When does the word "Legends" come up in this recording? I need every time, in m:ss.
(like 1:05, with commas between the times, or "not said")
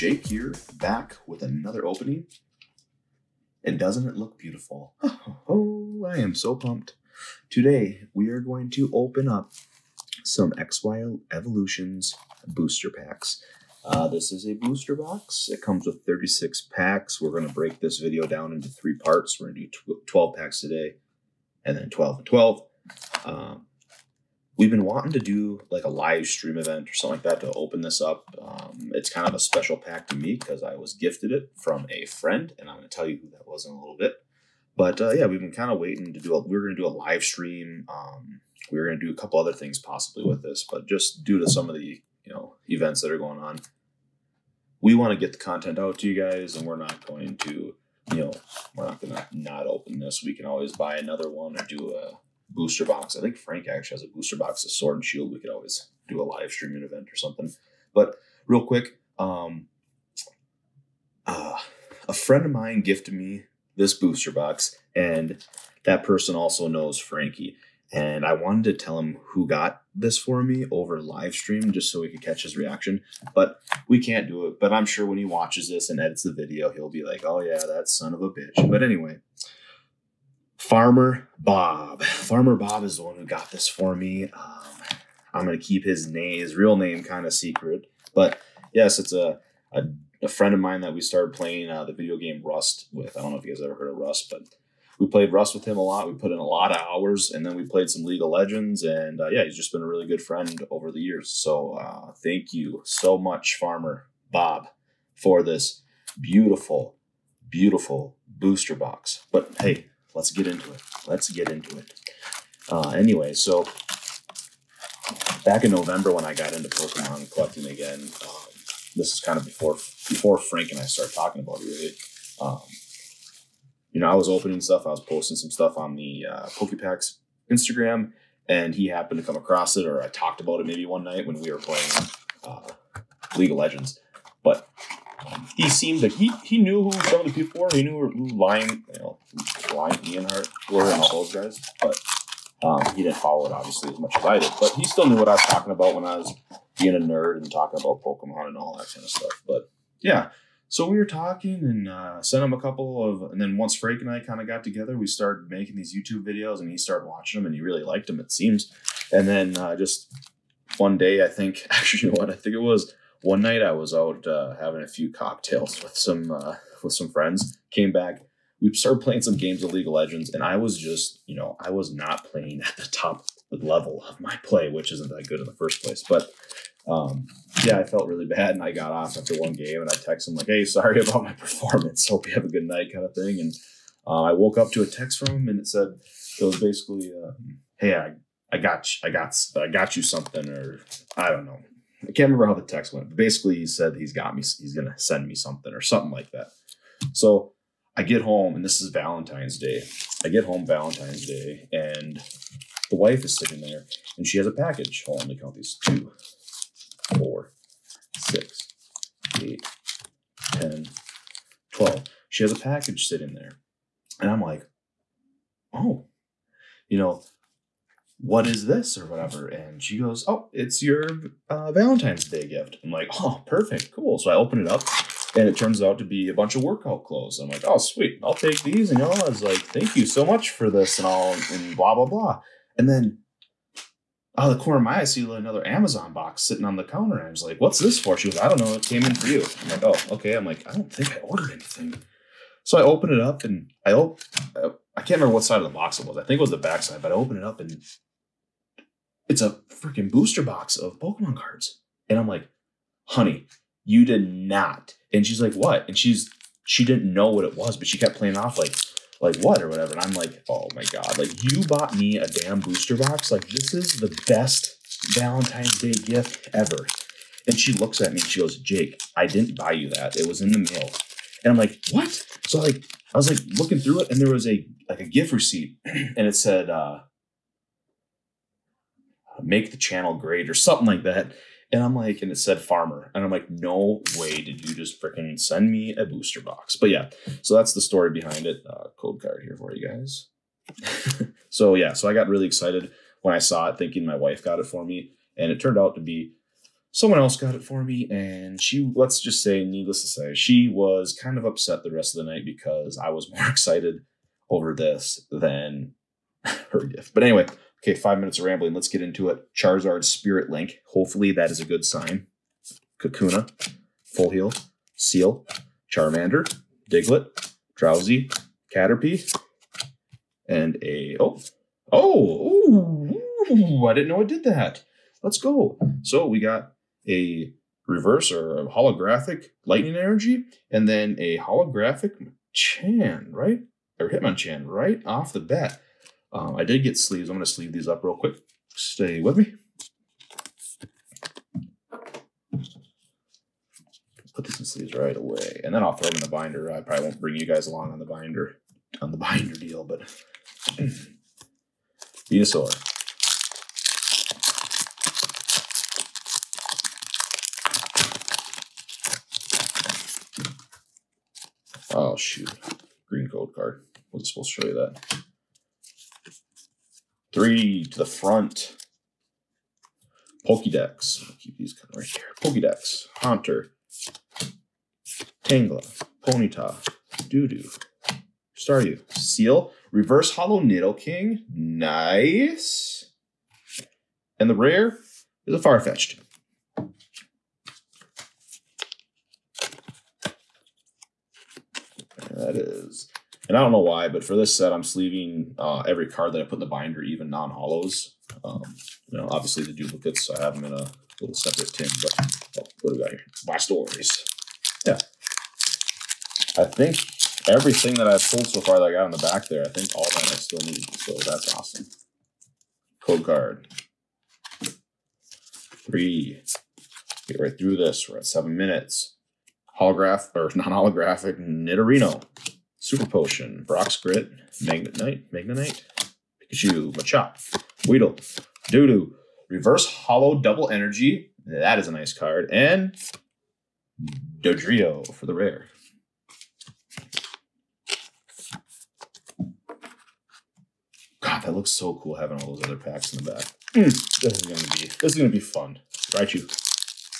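1:38, 2:13, 2:49.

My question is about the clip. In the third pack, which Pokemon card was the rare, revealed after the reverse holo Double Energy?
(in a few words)
Dodrio.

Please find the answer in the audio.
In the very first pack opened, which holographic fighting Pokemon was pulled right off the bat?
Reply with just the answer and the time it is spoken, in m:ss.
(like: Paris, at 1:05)
Hitmonchan, at 5:34.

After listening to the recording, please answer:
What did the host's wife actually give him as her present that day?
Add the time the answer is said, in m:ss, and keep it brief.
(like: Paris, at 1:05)
workout clothes, at 3:46.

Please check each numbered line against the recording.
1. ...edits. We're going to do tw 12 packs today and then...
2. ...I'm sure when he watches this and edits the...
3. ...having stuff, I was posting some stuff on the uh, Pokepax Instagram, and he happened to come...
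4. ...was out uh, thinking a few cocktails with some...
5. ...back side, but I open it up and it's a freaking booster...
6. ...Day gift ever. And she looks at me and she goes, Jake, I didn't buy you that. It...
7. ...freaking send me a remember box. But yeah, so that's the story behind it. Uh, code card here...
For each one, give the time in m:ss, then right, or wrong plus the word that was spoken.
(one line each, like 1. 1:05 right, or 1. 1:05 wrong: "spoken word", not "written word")
1. 0:18 wrong: "parts", not "edits"
2. 1:14 right
3. 2:04 wrong: "opening", not "having"
4. 2:43 wrong: "having", not "thinking"
5. 4:06 right
6. 4:25 right
7. 4:45 wrong: "booster", not "remember".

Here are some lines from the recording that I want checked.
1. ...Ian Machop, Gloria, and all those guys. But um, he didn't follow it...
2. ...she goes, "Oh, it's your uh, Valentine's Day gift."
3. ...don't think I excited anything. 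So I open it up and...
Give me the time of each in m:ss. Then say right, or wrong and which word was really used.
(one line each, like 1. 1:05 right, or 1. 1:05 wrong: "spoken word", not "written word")
1. 2:20 wrong: "Hart", not "Machop"
2. 3:39 right
3. 4:00 wrong: "ordered", not "excited".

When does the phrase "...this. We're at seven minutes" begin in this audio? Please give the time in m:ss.
6:57.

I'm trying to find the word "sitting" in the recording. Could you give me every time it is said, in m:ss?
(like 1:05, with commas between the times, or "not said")
3:23, 3:33, 3:56.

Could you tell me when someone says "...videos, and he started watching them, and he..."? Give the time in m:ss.
2:36.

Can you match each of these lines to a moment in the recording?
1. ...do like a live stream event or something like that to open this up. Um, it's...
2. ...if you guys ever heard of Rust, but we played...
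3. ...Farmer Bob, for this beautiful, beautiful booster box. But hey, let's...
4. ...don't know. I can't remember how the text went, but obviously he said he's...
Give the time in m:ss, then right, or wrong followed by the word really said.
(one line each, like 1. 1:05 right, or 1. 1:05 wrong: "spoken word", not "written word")
1. 0:25 right
2. 1:33 right
3. 1:43 right
4. 3:11 wrong: "basically", not "obviously".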